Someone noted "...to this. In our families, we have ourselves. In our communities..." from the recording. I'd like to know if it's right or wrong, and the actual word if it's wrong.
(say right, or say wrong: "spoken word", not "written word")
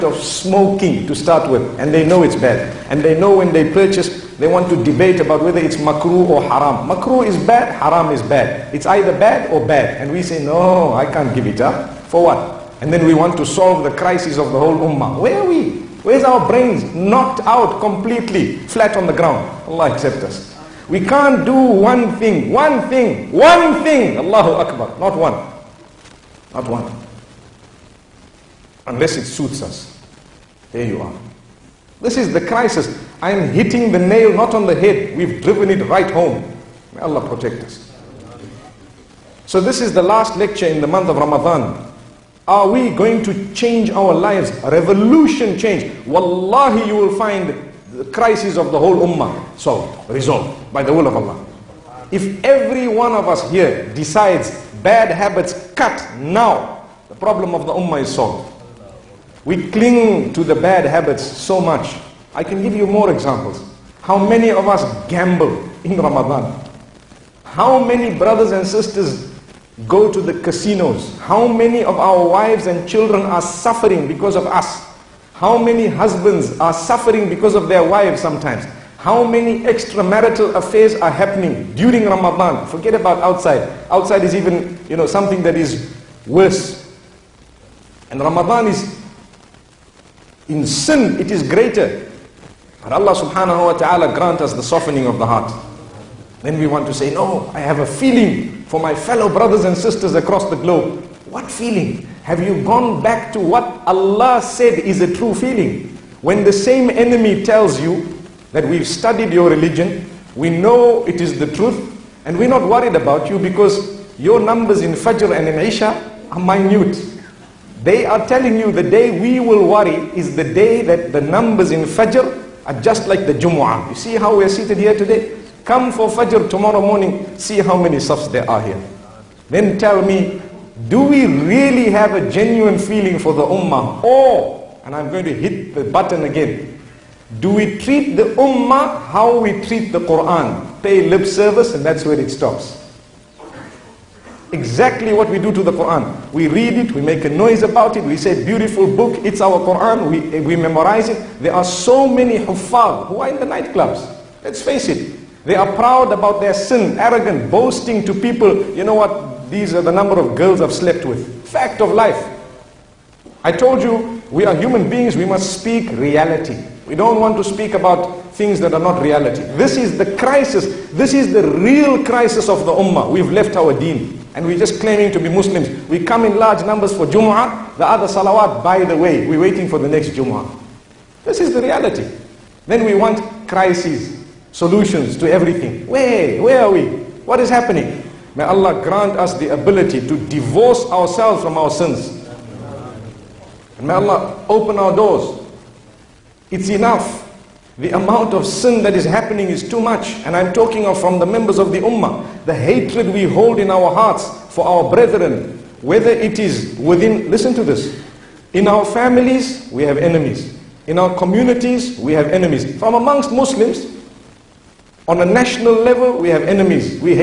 wrong: "enemies", not "ourselves".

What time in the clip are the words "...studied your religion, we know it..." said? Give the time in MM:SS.
01:48.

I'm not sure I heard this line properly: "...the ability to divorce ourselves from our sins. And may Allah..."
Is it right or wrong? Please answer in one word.
right.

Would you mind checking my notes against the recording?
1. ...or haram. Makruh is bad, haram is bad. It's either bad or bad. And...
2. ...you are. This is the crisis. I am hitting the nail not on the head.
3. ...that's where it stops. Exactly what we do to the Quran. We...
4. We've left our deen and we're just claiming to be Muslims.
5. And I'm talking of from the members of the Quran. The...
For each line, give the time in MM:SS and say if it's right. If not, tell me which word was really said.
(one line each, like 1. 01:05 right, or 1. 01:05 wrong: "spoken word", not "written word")
1. 00:06 right
2. 00:30 right
3. 02:21 right
4. 02:53 right
5. 03:20 wrong: "Ummah", not "Quran".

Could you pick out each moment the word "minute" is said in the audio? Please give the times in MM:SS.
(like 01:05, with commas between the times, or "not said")
01:56.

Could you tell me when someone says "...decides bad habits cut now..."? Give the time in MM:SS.
00:53.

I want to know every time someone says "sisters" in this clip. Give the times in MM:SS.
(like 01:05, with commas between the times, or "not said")
01:08, 01:39.